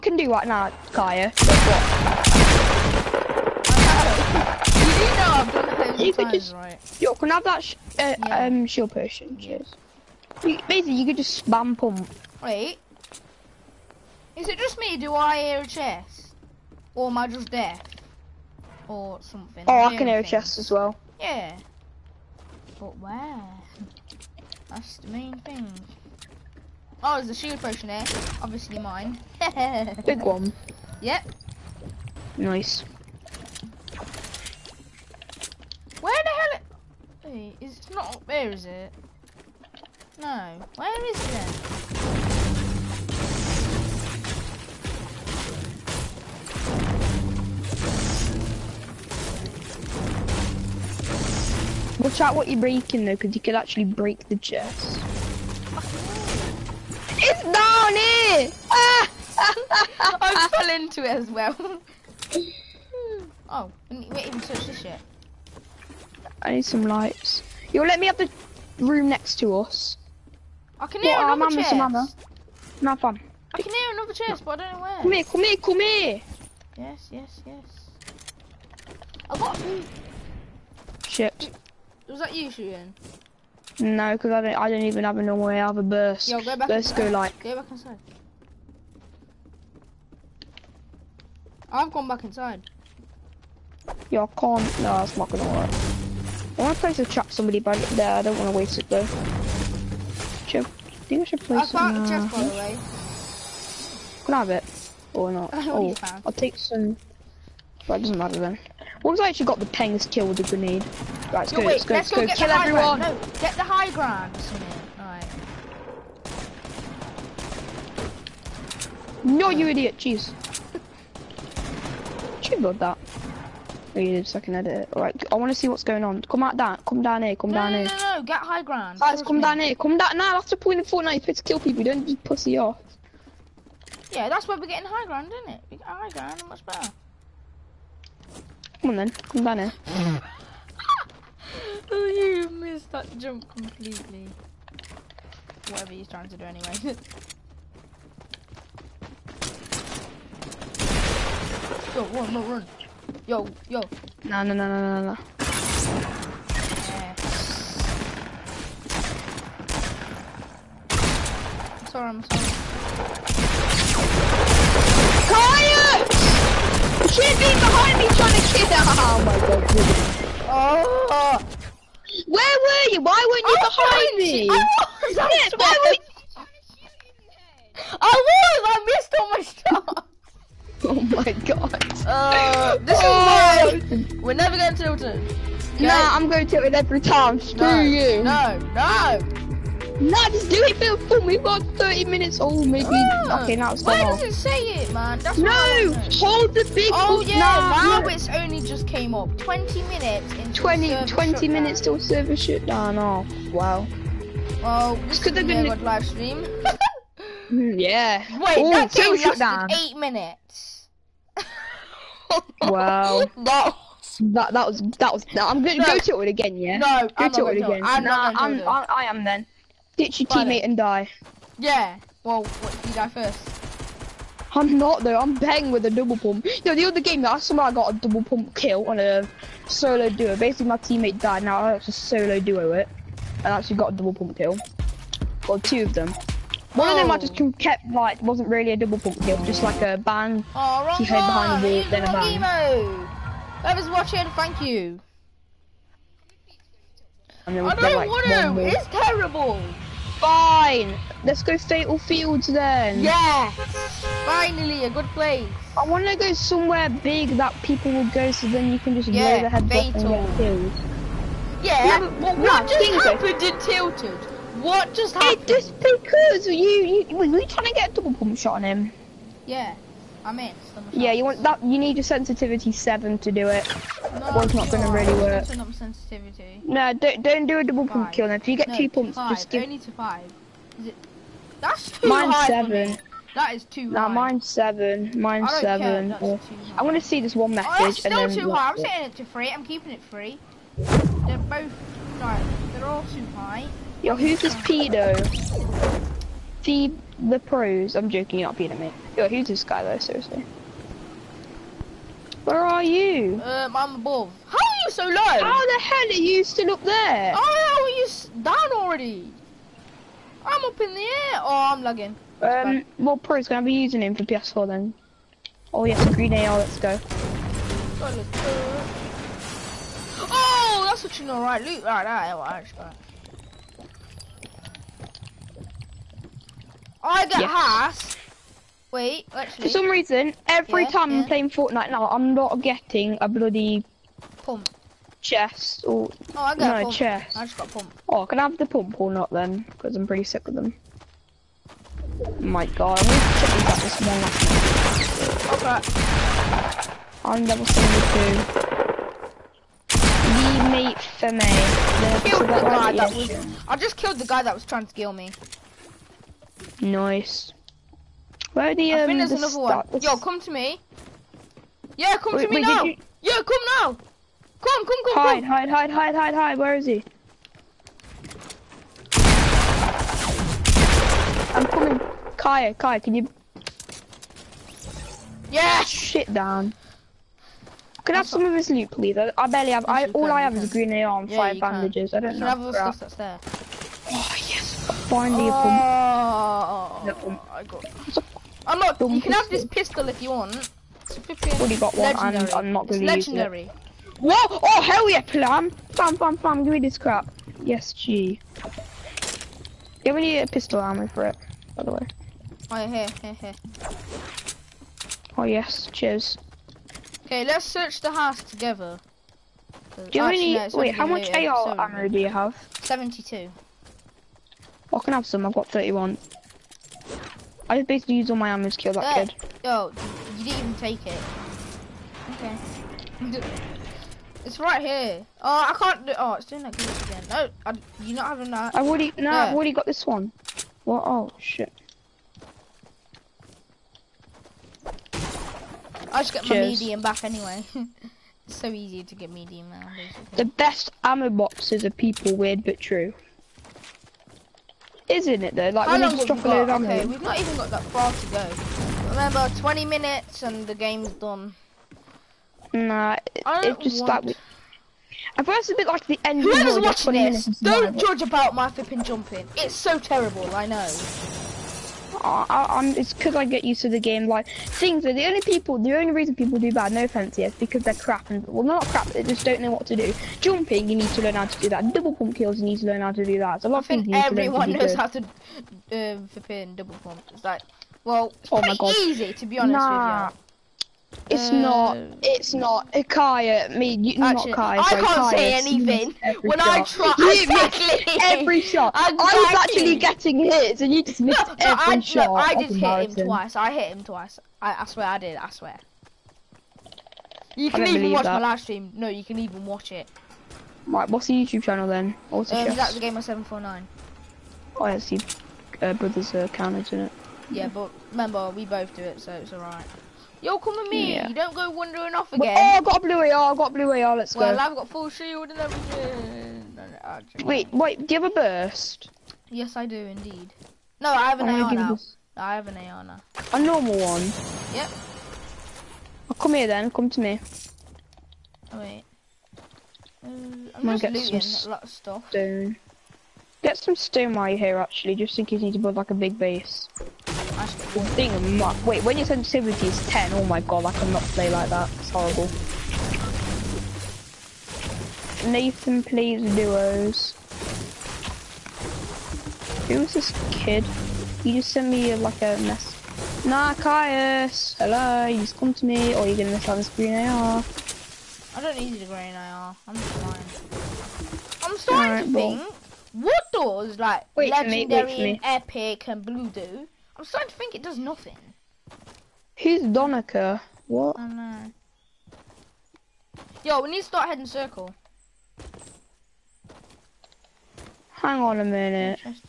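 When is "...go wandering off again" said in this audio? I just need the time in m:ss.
8:31.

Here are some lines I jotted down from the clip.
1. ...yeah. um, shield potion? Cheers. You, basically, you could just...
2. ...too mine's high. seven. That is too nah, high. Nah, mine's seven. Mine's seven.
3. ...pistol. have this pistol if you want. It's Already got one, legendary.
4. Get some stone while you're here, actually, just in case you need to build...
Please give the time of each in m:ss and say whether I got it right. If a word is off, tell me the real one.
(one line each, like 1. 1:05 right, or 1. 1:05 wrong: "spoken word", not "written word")
1. 0:08 right
2. 4:41 right
3. 6:29 right
4. 8:53 right.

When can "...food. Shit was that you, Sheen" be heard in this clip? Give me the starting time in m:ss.
1:19.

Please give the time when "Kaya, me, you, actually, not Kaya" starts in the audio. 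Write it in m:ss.
8:03.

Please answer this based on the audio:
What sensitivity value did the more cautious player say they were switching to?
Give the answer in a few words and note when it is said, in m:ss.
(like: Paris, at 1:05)
3, at 4:48.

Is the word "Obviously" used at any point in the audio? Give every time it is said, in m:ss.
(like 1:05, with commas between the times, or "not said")
0:28.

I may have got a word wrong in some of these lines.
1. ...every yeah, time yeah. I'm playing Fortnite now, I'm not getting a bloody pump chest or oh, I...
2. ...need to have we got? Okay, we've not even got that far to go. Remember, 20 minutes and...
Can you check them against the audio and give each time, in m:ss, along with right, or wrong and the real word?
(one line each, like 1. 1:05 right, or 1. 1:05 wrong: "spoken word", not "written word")
1. 5:30 right
2. 7:26 right.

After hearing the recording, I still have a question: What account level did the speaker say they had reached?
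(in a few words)
72.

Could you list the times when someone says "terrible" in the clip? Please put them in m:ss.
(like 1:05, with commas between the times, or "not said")
4:08, 7:39.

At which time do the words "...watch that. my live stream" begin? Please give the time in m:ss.
8:18.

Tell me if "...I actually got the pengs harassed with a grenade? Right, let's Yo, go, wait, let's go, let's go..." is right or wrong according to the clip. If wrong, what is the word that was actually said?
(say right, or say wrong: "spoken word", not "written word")
wrong: "killed", not "harassed".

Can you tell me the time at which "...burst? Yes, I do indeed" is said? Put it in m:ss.
8:38.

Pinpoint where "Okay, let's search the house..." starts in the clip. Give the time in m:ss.
6:47.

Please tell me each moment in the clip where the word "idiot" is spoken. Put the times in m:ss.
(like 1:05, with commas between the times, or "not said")
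1:59.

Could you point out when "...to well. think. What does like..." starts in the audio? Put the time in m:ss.
9:22.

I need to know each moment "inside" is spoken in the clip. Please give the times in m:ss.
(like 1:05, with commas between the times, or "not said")
1:27, 1:32.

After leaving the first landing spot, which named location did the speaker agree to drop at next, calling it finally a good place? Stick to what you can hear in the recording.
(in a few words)
Fatal Fields.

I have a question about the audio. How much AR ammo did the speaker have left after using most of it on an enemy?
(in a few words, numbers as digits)
31.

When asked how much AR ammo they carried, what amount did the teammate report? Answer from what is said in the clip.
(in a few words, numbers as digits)
72.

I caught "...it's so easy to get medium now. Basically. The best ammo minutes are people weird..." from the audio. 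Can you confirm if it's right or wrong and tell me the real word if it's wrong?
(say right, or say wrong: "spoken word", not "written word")
wrong: "boxes", not "minutes".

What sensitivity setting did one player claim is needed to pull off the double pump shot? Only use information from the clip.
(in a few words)
7.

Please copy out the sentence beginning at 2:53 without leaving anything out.
Why weren't you I behind me?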